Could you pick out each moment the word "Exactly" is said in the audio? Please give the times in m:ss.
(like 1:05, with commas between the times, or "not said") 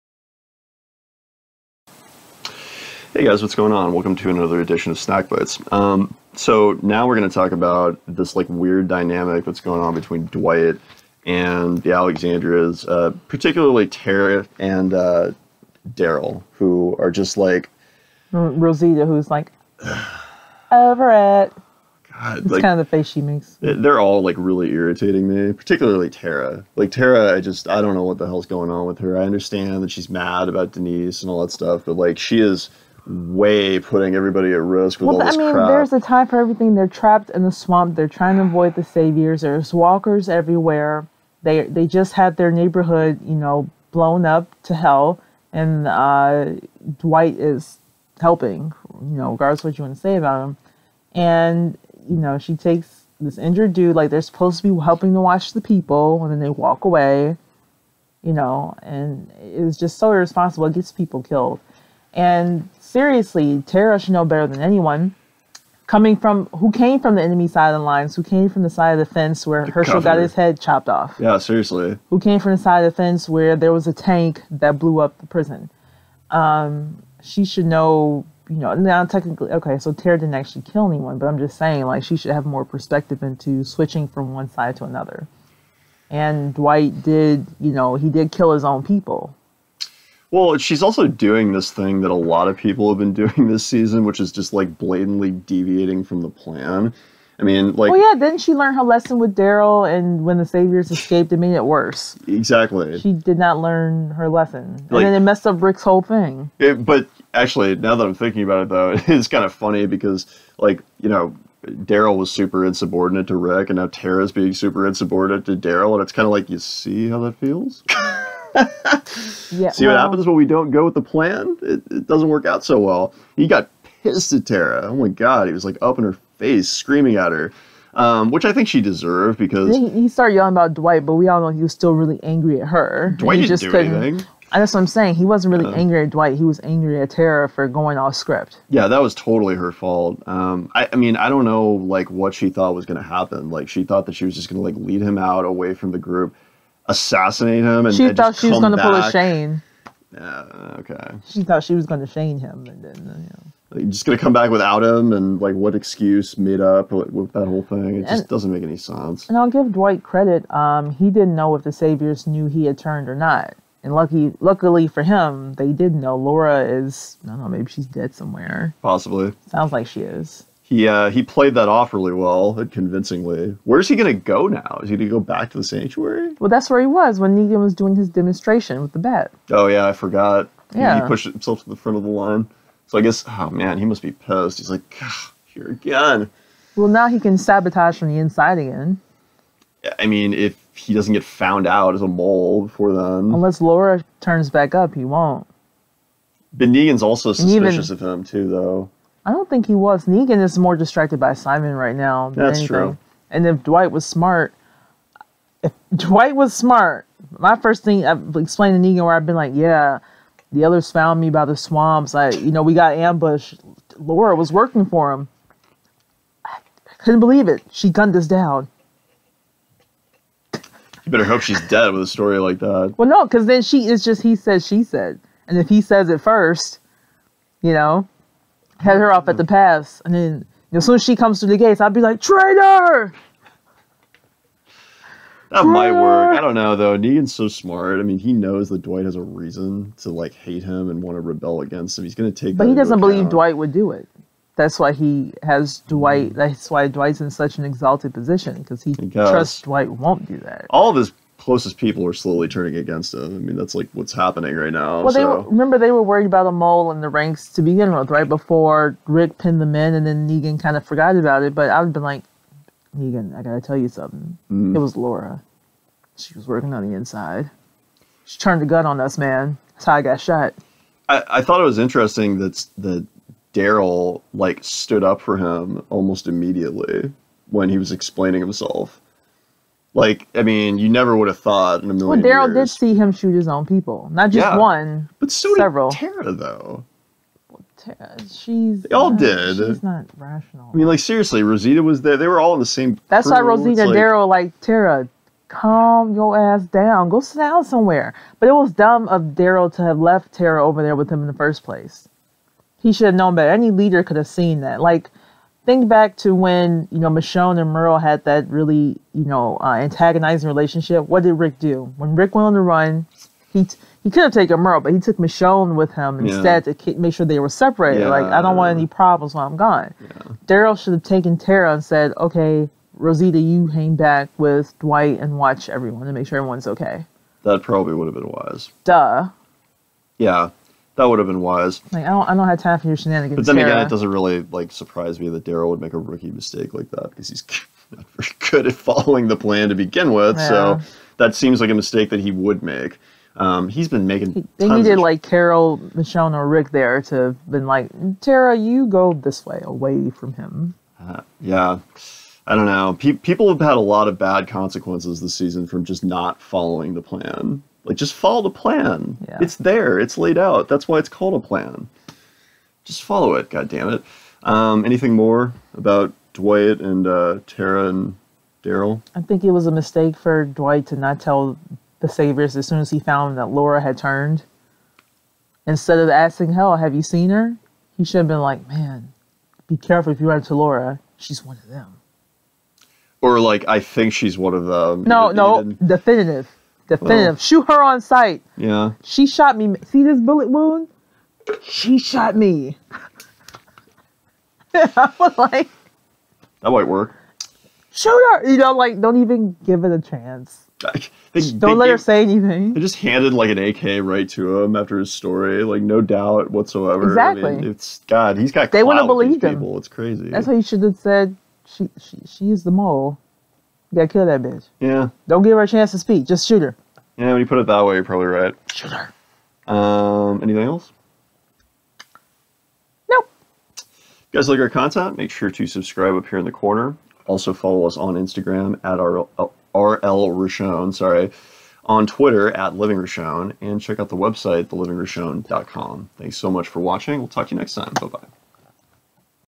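1:42, 6:47.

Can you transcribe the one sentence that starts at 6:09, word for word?
I think it was a mistake for Dwight to not tell the Saviors as soon as he found that Laura had turned.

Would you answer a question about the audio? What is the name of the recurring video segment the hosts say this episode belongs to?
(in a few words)
Snack Bites.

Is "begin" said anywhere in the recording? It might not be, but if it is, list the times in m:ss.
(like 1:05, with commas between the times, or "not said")
4:17, 5:39.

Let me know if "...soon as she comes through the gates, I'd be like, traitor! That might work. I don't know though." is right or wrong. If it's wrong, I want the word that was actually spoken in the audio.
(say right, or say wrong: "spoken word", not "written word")
right.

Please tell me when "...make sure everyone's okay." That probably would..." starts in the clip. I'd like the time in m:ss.
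5:26.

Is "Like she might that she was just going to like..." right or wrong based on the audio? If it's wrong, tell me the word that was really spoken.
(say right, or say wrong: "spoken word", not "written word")
wrong: "thought", not "might".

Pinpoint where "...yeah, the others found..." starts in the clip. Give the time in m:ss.
3:29.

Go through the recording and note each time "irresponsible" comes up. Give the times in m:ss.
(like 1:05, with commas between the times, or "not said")
1:00.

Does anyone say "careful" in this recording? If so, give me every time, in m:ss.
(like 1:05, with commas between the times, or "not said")
6:19.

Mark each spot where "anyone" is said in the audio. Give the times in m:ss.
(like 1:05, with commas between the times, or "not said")
1:04, 1:20.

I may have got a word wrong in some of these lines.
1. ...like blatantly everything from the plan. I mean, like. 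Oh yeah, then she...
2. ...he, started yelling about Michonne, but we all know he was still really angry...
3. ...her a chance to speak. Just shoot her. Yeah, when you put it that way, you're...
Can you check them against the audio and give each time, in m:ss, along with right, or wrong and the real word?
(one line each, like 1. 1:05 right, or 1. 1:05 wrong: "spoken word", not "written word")
1. 1:34 wrong: "deviating", not "everything"
2. 2:09 wrong: "Dwight", not "Michonne"
3. 6:55 right.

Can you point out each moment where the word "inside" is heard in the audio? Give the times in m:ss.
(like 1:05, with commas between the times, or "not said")
3:08, 4:26.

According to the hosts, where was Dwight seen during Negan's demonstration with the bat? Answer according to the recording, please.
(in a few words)
the sanctuary.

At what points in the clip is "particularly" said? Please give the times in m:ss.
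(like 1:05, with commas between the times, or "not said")
0:13, 0:25.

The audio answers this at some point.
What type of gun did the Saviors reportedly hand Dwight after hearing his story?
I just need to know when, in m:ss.
6:43.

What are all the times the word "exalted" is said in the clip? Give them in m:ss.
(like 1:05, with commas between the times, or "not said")
4:07.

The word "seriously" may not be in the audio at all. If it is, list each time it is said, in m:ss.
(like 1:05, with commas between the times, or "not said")
1:02, 1:11, 4:50.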